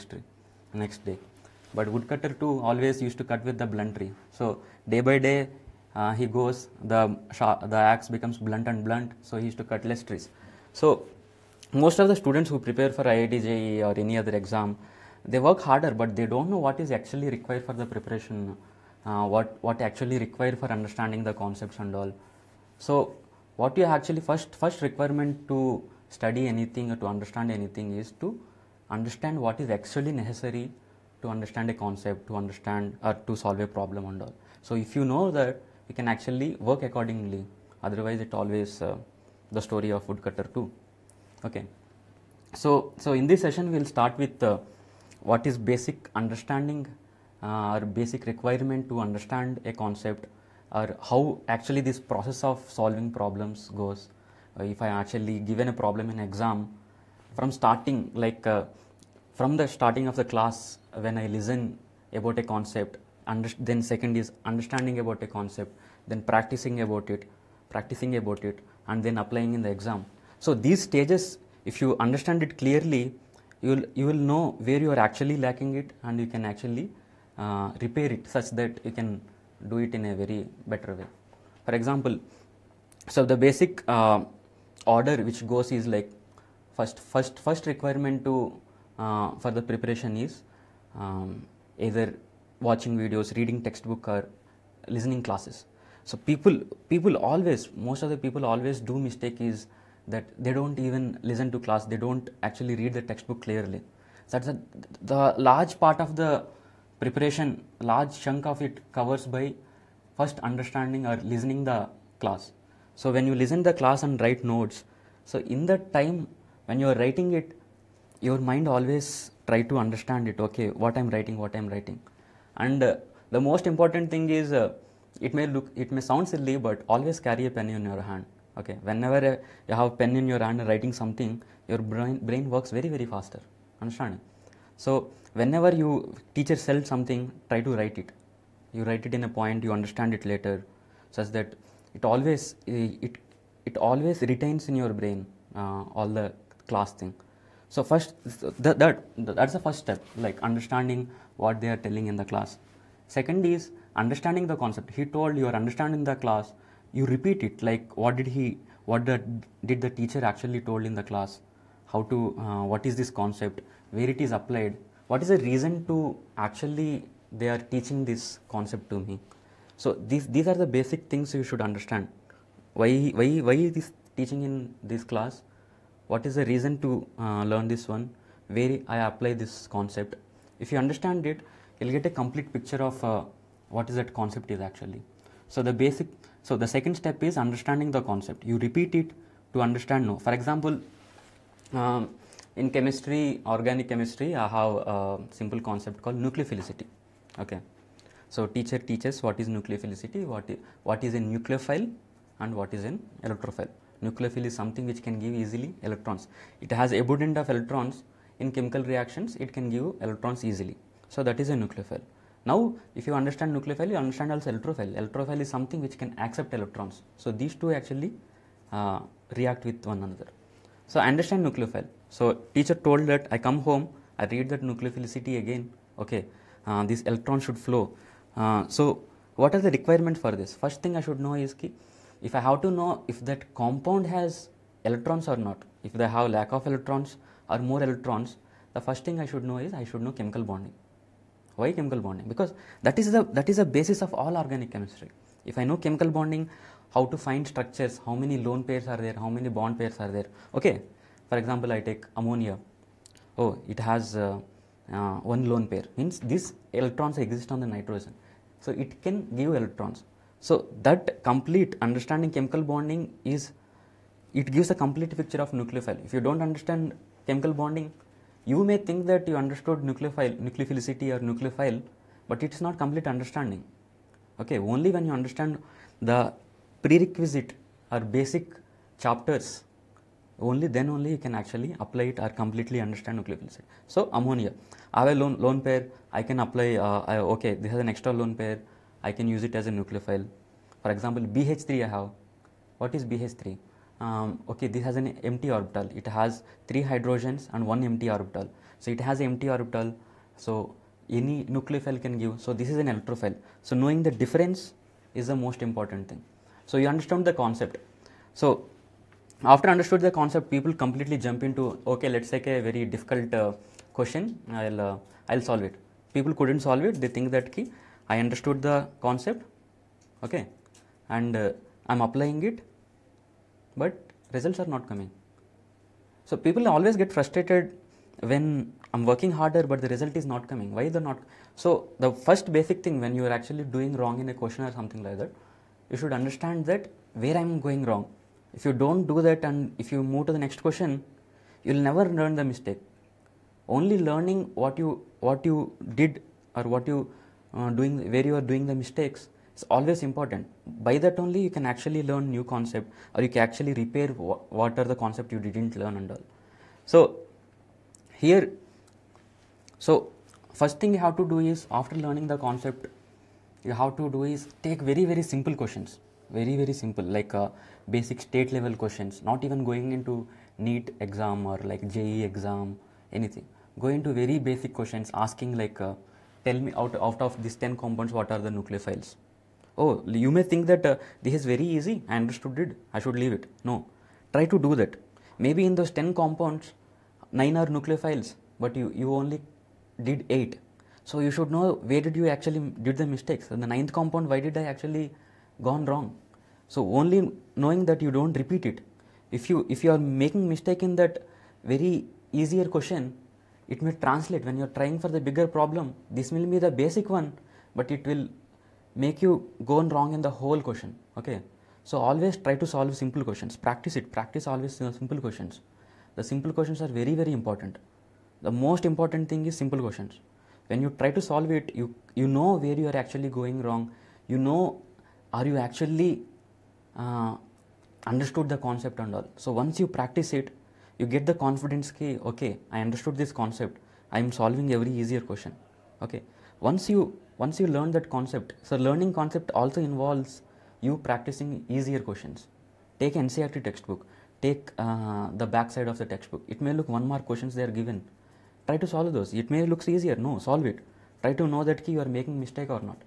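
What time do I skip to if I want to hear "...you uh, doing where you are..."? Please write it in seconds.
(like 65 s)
346 s.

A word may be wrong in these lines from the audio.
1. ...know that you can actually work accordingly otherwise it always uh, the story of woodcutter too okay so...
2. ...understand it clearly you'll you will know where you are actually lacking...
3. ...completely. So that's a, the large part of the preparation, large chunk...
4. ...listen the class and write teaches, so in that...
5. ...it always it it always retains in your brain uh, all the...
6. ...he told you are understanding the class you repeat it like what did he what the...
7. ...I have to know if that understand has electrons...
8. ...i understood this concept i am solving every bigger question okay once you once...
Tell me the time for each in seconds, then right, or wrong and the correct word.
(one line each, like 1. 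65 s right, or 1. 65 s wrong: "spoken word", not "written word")
1. 35 s right
2. 71 s right
3. 103 s wrong: "clearly", not "completely"
4. 113 s wrong: "notes", not "teaches"
5. 141 s right
6. 155 s right
7. 232 s wrong: "compound", not "understand"
8. 432 s wrong: "easier", not "bigger".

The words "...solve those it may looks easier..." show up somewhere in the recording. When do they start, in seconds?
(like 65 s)
448 s.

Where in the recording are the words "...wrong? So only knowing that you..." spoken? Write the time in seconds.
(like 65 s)
395 s.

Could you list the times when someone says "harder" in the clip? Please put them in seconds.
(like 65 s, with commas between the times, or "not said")
15 s, 329 s.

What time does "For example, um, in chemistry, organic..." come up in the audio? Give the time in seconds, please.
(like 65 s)
190 s.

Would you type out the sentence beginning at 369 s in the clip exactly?
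Not even going into NEET exam or like JEE exam anything.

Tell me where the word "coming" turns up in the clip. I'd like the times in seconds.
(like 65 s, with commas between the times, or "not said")
324 s, 330 s.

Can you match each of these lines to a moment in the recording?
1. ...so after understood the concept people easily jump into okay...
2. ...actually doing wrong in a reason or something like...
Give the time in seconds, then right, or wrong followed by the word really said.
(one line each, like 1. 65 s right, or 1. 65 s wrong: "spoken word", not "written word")
1. 308 s wrong: "completely", not "easily"
2. 333 s wrong: "question", not "reason".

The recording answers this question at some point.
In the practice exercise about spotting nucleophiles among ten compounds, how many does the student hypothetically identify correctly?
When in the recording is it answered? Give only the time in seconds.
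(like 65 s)
390 s.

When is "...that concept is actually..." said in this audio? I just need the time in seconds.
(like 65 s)
183 s.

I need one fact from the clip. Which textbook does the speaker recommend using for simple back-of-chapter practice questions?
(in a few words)
NCERT.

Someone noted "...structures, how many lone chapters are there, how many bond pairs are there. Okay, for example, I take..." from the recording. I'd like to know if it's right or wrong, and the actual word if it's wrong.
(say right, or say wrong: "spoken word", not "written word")
wrong: "pairs", not "chapters".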